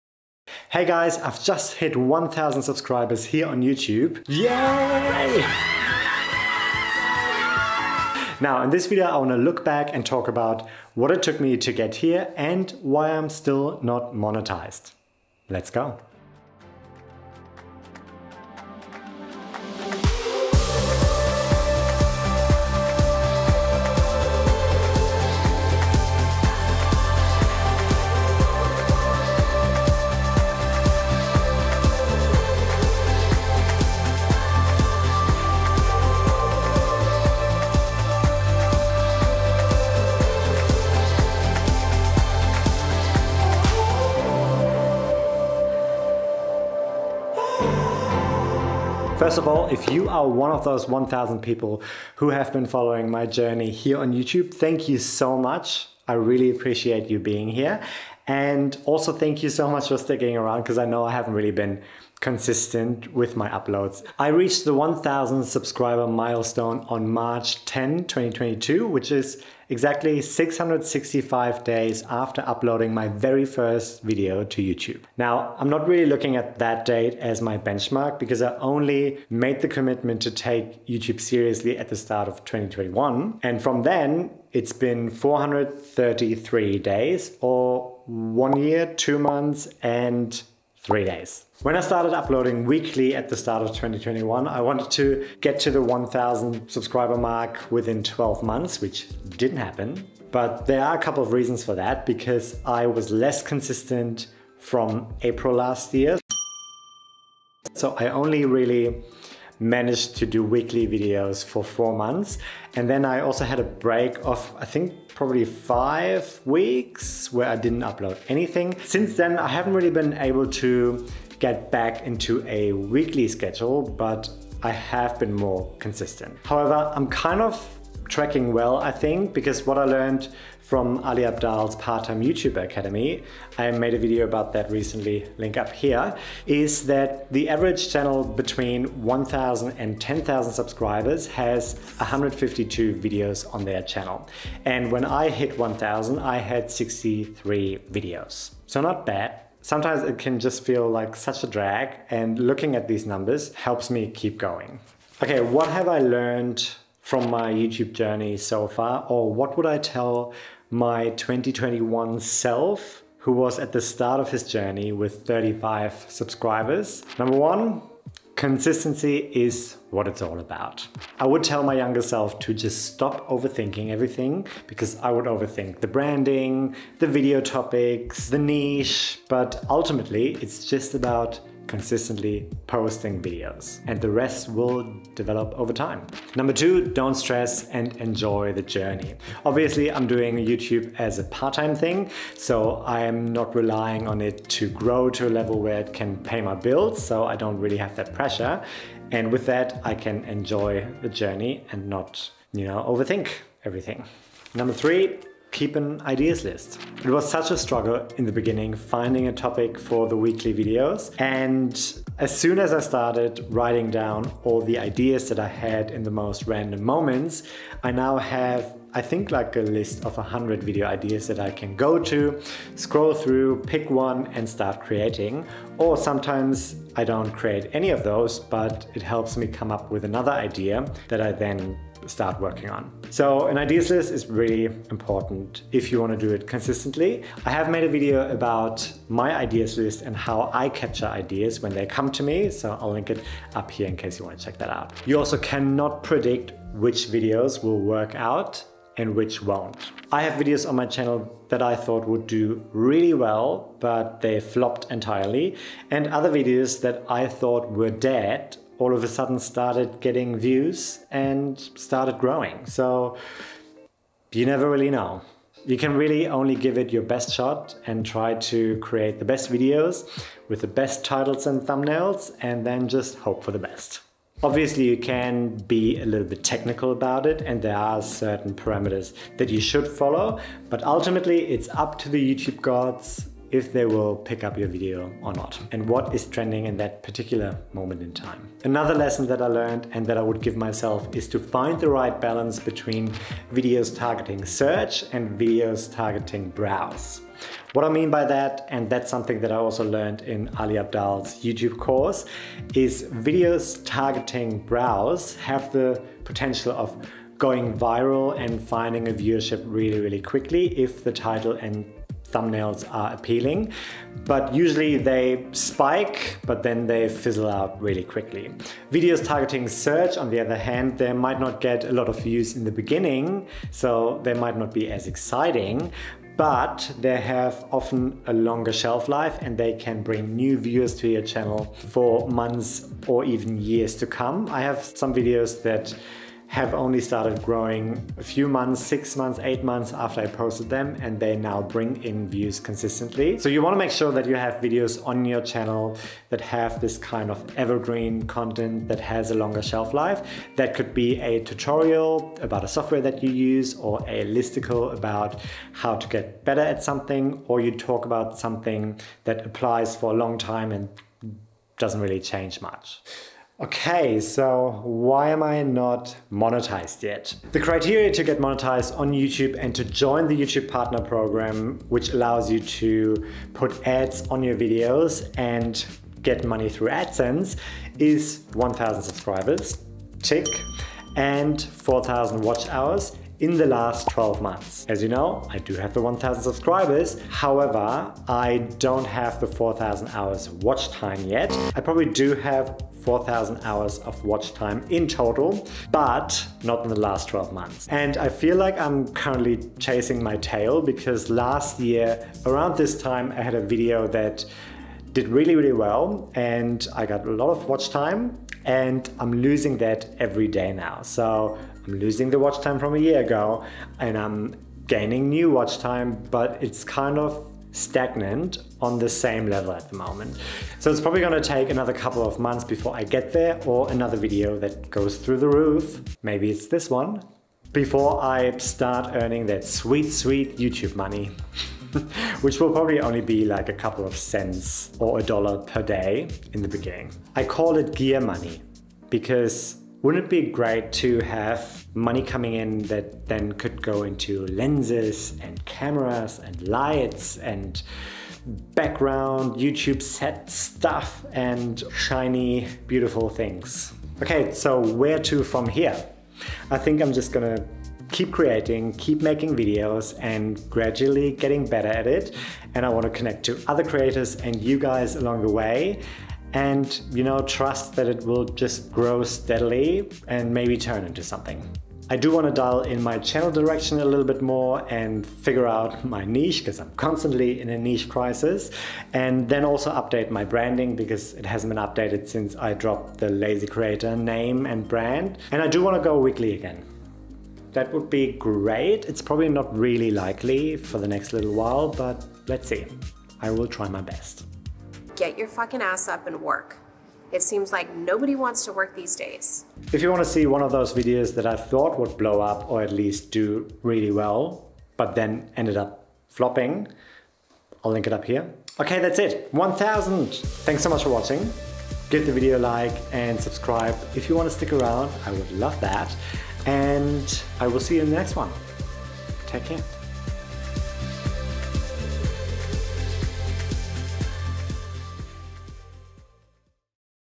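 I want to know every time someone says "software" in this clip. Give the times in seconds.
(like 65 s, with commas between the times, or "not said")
352 s.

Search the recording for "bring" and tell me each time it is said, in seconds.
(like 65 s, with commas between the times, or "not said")
330 s, 341 s.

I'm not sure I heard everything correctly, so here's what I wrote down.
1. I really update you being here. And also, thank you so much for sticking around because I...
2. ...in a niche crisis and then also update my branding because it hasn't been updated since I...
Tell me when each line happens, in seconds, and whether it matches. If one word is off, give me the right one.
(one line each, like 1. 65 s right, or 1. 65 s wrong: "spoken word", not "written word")
1. 56 s wrong: "appreciate", not "update"
2. 477 s right.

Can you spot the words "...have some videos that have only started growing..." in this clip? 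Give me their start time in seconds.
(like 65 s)
334 s.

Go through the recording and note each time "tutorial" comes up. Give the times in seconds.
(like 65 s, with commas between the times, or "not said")
351 s.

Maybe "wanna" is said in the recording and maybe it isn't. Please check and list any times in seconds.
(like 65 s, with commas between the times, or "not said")
9 s, 343 s.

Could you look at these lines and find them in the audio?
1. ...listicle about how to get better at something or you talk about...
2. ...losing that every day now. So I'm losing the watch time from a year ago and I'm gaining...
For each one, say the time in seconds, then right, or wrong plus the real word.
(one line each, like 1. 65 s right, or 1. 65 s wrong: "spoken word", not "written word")
1. 354 s right
2. 409 s right.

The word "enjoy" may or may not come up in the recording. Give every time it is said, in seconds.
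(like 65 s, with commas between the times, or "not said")
188 s, 200 s.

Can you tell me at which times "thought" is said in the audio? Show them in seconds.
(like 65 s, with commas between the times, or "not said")
251 s, 257 s, 501 s.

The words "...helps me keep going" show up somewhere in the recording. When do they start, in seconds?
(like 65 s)
153 s.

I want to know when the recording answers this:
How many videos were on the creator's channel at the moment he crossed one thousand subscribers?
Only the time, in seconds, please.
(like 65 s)
146 s.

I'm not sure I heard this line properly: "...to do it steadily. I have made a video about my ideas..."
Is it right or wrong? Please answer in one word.
wrong.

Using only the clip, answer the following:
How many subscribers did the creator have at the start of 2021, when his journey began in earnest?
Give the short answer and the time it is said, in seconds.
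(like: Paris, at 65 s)
35, at 165 s.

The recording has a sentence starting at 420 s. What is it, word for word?
So it's probably gonna take another couple of months before I get there or another video that goes through the roof.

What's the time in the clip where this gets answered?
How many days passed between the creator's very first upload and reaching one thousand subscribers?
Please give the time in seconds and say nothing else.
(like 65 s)
70 s.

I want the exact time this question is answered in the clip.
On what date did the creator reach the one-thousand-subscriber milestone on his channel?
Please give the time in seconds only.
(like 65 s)
67 s.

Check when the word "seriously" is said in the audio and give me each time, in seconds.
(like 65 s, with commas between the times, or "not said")
81 s.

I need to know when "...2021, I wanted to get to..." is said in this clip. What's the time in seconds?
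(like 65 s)
93 s.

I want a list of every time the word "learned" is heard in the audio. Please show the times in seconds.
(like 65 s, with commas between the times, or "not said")
129 s, 155 s, 289 s, 299 s.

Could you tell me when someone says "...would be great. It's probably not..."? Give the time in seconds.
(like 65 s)
487 s.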